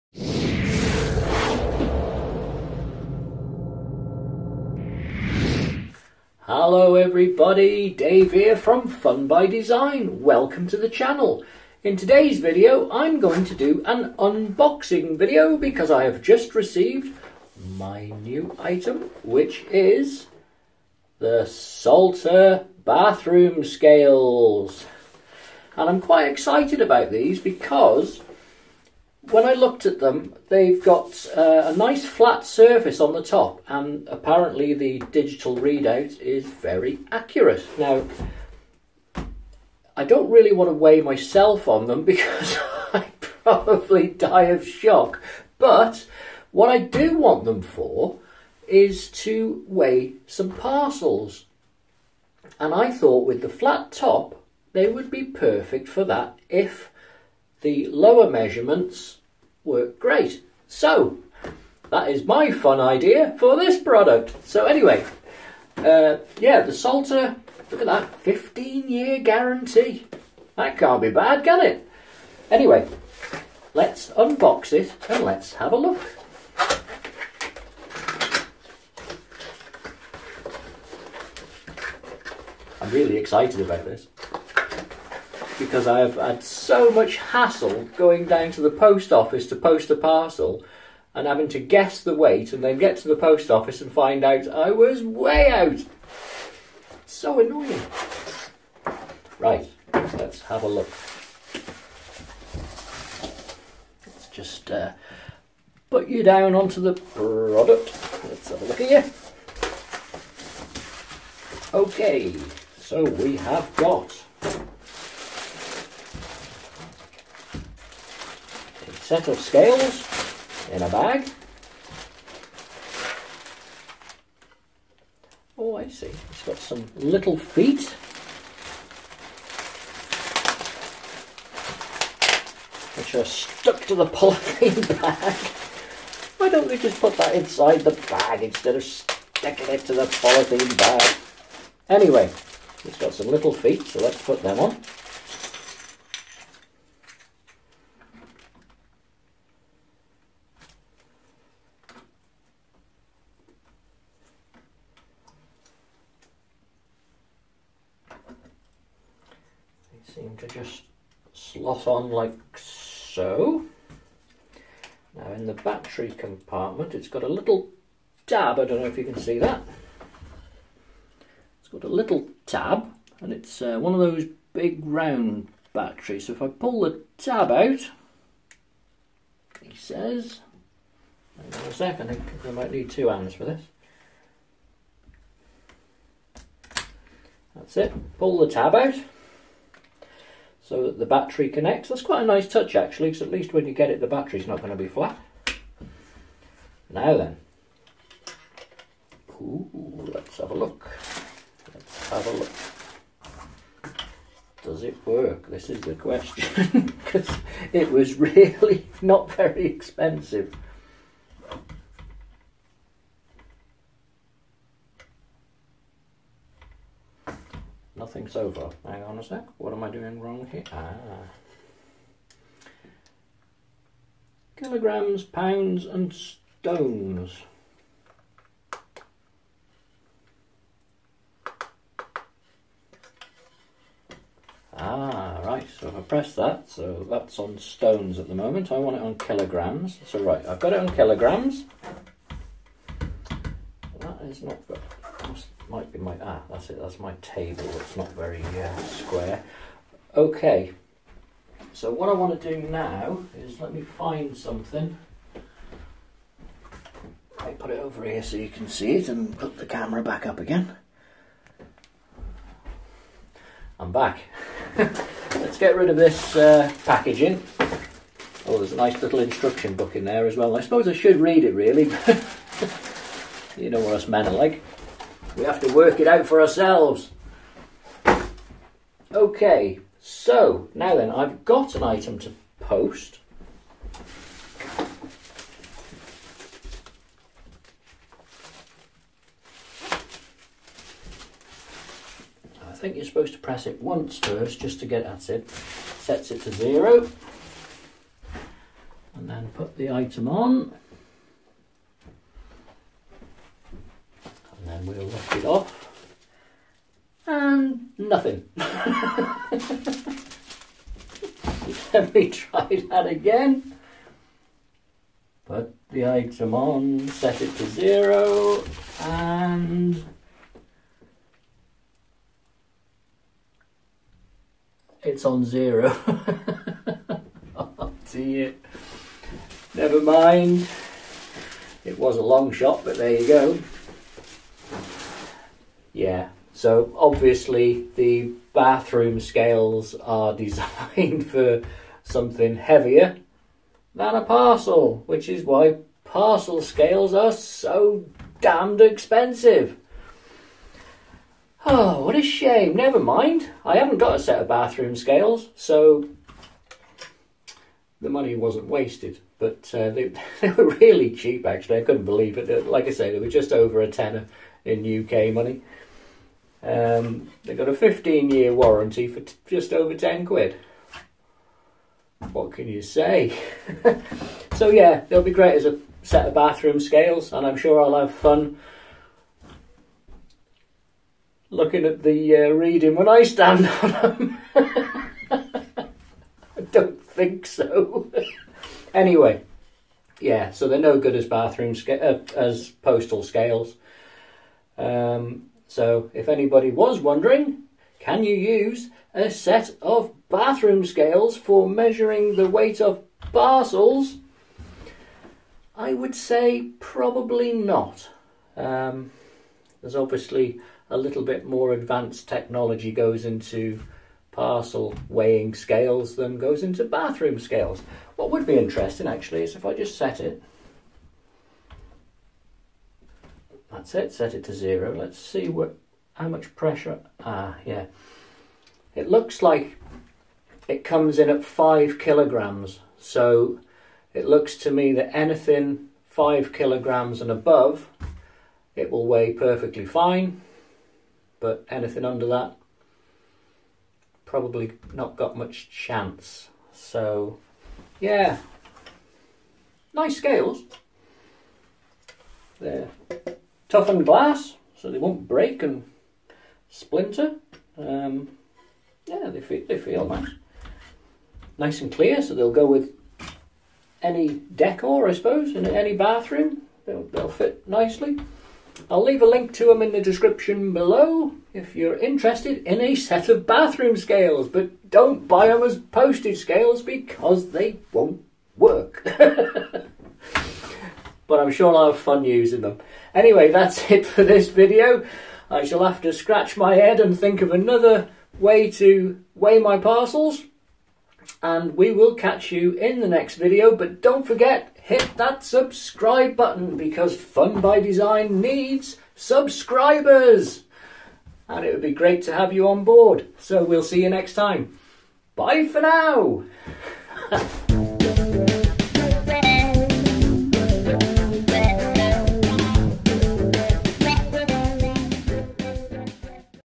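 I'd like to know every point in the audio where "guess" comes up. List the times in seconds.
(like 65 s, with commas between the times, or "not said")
91 s.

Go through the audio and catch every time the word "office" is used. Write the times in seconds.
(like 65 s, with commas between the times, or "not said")
89 s, 93 s.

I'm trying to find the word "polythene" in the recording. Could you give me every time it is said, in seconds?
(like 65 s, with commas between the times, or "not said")
134 s, 140 s.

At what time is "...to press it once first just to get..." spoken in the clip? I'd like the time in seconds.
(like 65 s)
293 s.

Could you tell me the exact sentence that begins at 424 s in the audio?
Let's see what how much pressure, ah, yeah.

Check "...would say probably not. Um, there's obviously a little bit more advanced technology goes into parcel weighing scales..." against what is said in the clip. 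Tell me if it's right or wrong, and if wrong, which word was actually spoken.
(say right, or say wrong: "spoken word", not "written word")
right.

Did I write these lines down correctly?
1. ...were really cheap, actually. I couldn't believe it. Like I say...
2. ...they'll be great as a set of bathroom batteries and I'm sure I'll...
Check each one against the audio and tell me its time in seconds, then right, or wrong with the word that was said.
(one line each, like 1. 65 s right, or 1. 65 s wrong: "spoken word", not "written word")
1. 360 s right
2. 375 s wrong: "scales", not "batteries".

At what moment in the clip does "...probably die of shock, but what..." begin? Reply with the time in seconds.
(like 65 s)
43 s.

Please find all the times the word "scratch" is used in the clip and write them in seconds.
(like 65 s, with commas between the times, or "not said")
486 s.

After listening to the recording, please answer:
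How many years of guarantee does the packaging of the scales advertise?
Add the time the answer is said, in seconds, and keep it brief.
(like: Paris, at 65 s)
15 years, at 68 s.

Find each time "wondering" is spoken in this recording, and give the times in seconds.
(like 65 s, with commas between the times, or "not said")
396 s.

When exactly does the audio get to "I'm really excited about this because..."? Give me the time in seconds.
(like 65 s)
82 s.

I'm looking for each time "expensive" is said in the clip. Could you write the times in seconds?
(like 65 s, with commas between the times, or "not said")
209 s, 348 s.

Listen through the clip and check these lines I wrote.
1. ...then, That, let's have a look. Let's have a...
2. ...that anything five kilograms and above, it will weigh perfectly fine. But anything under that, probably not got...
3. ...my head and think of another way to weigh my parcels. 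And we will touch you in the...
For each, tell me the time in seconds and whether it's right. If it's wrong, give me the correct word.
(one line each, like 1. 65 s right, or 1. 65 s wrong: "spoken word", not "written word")
1. 197 s wrong: "Ooh", not "That"
2. 434 s right
3. 486 s wrong: "catch", not "touch".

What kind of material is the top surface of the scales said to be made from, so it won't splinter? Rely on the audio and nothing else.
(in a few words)
toughened glass.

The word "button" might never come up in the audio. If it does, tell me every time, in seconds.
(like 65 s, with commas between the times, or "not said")
496 s.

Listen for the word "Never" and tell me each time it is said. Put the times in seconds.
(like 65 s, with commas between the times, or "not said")
329 s, 352 s.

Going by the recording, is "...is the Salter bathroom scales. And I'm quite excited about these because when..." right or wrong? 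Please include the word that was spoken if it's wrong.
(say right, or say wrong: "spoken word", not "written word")
right.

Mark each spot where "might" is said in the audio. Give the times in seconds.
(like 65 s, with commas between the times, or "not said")
182 s, 245 s.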